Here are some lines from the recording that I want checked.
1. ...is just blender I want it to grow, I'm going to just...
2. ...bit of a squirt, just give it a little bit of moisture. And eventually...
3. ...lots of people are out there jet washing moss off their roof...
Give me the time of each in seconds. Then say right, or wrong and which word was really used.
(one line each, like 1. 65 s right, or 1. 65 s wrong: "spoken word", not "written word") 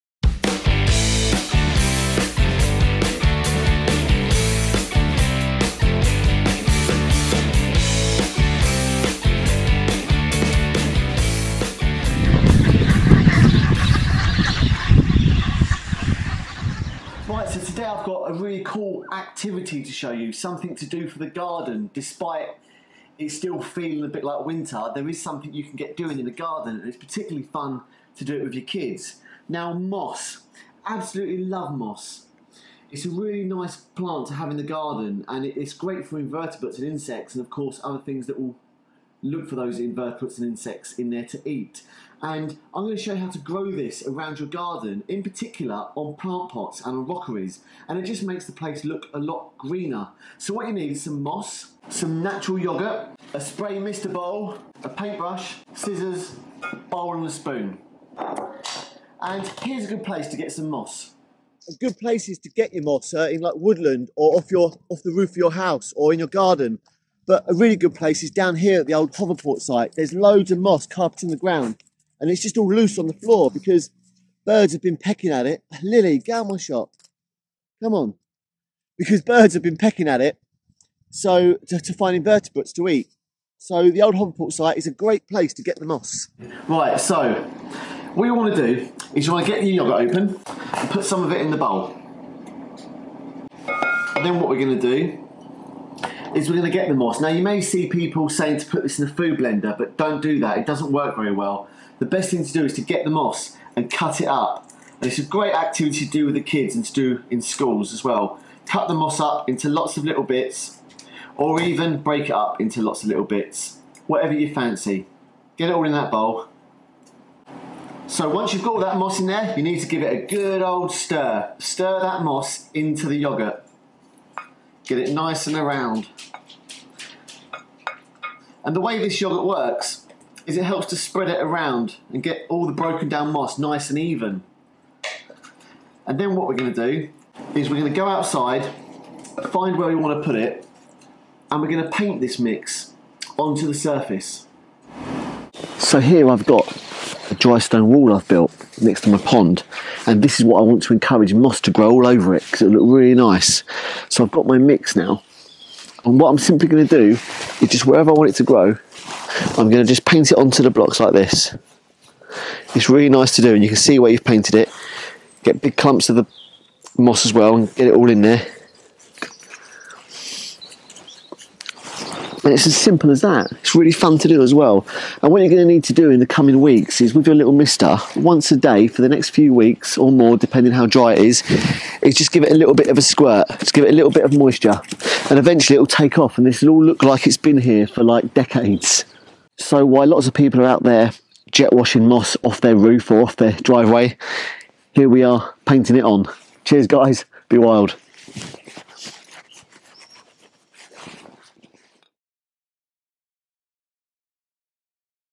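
1. 157 s wrong: "wherever", not "blender"
2. 182 s right
3. 190 s right.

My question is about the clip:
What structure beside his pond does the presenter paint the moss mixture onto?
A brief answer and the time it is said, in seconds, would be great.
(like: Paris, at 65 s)
A dry stone wall, at 147 s.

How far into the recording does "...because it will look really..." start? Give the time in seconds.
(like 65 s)
152 s.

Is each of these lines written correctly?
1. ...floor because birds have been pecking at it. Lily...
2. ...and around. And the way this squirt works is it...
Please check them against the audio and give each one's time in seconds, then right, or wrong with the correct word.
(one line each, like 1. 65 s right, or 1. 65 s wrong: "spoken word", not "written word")
1. 73 s right
2. 125 s wrong: "yogurt", not "squirt".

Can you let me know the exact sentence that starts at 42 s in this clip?
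And I'm going to show you how to grow this around your garden, in particular on plant pots and on rockeries.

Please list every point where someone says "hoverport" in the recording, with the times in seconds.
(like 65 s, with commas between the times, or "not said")
69 s, 84 s.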